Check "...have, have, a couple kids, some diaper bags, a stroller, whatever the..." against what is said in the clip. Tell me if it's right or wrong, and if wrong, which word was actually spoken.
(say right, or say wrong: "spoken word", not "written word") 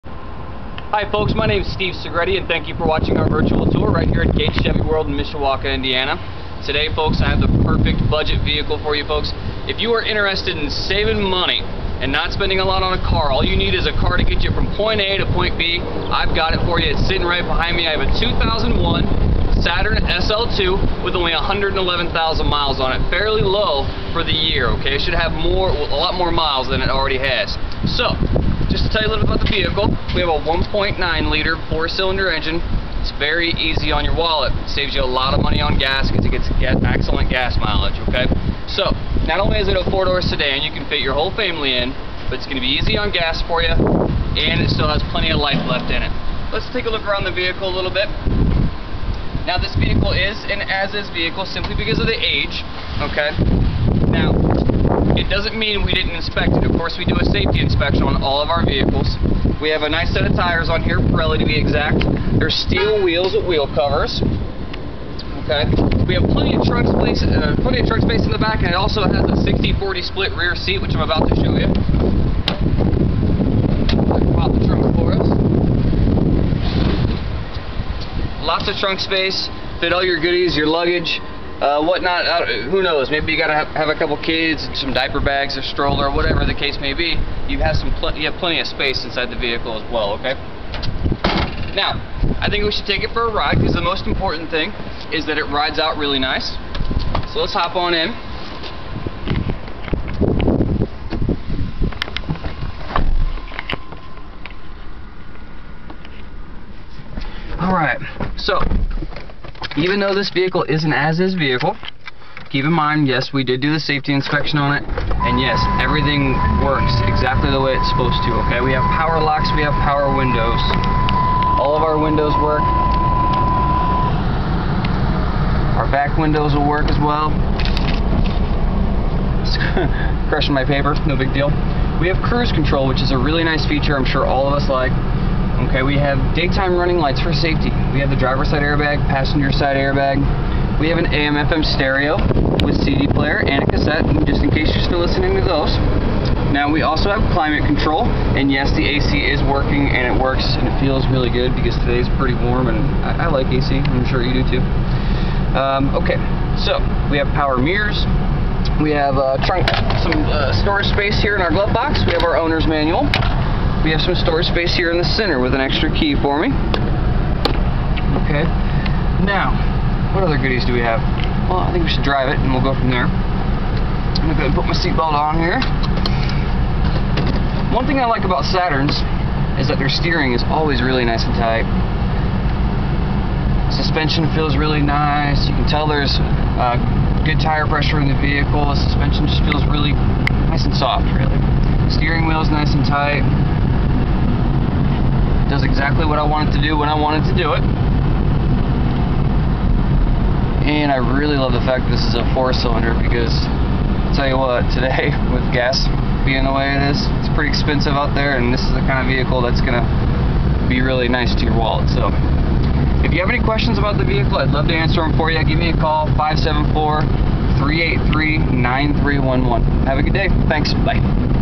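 right.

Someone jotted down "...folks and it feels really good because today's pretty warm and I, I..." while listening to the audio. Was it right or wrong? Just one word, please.
wrong.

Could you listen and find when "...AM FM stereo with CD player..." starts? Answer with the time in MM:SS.
02:21.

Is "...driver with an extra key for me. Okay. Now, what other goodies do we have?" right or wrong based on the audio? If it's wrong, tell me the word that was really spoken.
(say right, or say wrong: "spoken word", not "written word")
wrong: "center", not "driver".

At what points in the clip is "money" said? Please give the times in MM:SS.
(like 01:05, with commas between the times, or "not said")
00:11, 00:35.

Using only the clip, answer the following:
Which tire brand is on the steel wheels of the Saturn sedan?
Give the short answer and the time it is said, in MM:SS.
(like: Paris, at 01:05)
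Pirelli, at 01:00.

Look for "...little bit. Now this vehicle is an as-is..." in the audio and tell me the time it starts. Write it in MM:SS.
00:47.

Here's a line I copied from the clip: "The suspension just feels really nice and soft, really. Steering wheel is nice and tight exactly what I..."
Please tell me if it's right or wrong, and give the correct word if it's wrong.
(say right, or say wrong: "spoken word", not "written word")
right.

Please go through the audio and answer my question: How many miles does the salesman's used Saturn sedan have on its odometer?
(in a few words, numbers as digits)
111,000.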